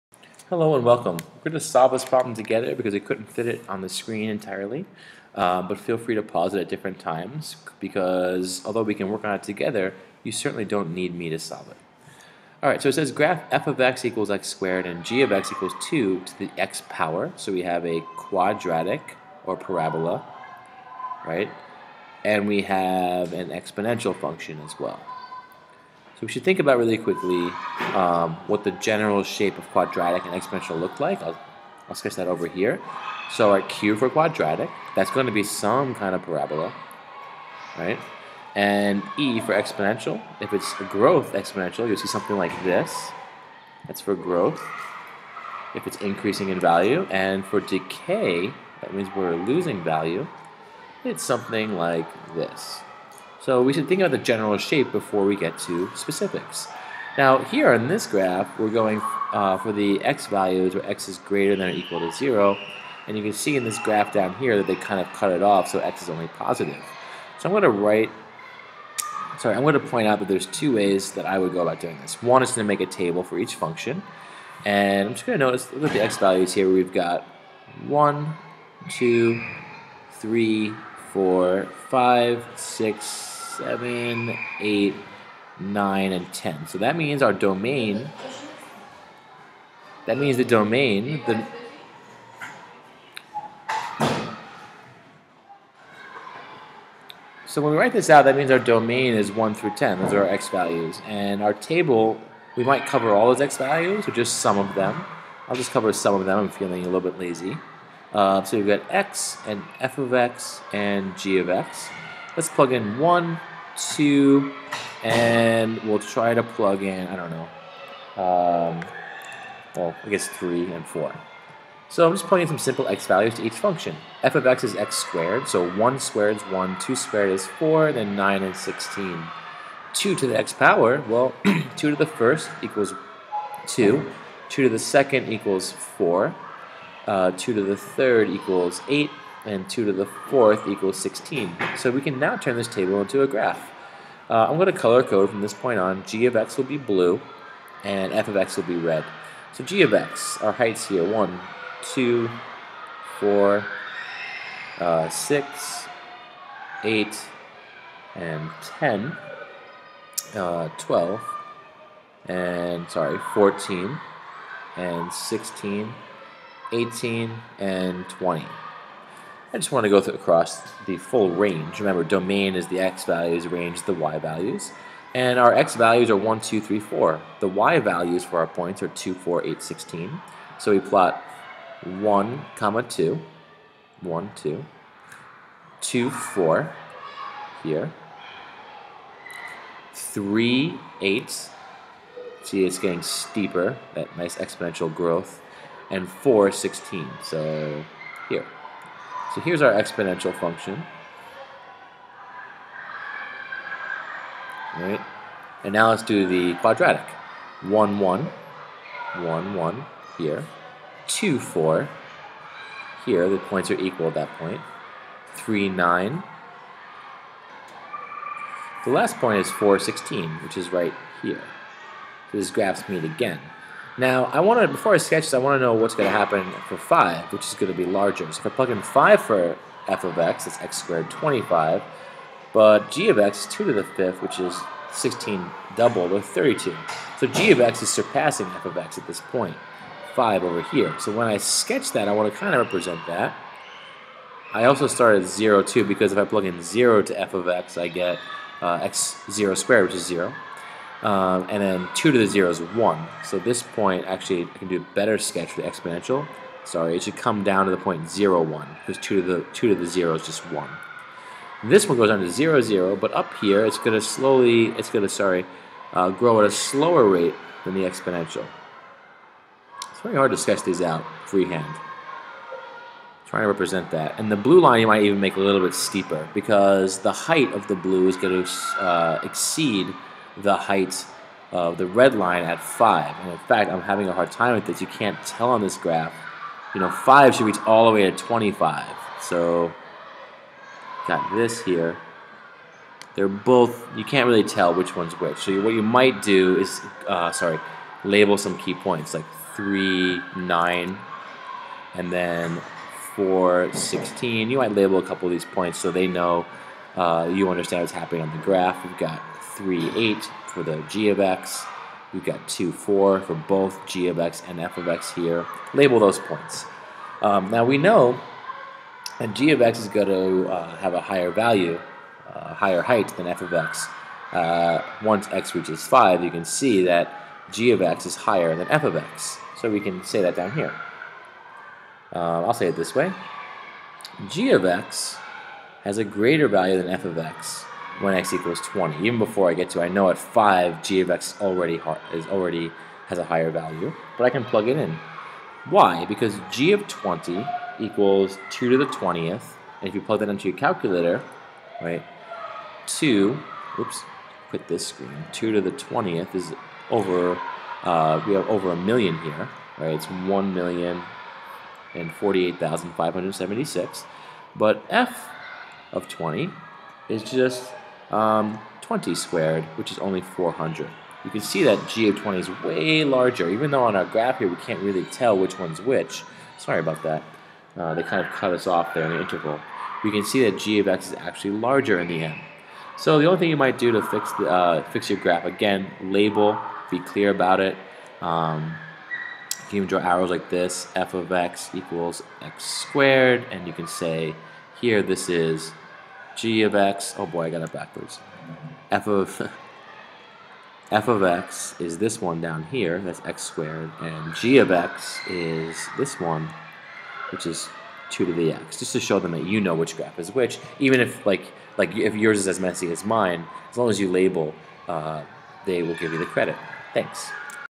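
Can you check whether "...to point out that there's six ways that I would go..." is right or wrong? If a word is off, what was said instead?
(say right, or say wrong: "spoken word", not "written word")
wrong: "two", not "six".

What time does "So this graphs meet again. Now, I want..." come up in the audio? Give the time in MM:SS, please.
03:42.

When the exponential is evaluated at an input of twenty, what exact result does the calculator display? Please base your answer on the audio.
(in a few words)
1,048,576.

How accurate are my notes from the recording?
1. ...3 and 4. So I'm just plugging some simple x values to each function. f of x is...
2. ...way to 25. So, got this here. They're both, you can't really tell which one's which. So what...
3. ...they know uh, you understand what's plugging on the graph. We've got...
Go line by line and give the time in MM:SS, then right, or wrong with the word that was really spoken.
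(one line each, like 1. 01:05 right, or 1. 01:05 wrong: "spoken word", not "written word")
1. 02:00 right
2. 04:47 right
3. 05:05 wrong: "happening", not "plugging".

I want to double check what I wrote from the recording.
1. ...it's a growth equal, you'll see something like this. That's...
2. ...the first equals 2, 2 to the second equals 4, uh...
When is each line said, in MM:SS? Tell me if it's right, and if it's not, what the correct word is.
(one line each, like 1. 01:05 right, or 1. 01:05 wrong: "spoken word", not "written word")
1. 00:40 wrong: "exponential", not "equal"
2. 02:11 right.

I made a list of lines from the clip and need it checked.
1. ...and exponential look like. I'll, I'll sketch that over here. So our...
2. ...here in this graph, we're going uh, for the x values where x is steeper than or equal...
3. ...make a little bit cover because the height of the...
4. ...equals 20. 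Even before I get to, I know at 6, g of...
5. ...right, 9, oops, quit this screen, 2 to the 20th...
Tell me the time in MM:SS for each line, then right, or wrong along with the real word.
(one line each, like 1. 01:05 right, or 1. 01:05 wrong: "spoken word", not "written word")
1. 00:30 right
2. 00:57 wrong: "greater", not "steeper"
3. 04:35 wrong: "steeper", not "cover"
4. 05:38 wrong: "5", not "6"
5. 05:51 wrong: "2", not "9".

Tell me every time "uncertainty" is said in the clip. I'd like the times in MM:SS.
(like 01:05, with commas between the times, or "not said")
not said.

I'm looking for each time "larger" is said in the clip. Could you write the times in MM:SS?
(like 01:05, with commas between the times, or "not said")
03:47, 06:13, 06:21.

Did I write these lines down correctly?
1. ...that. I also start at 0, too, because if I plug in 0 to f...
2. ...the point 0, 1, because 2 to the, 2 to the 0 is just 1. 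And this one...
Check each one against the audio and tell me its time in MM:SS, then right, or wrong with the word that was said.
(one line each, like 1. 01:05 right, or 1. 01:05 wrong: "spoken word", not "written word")
1. 04:03 right
2. 04:17 right.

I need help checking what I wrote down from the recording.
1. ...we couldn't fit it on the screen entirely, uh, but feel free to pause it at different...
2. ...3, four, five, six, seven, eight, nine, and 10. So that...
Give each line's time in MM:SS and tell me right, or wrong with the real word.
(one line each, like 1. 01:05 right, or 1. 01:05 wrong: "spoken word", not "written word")
1. 00:02 right
2. 01:20 right.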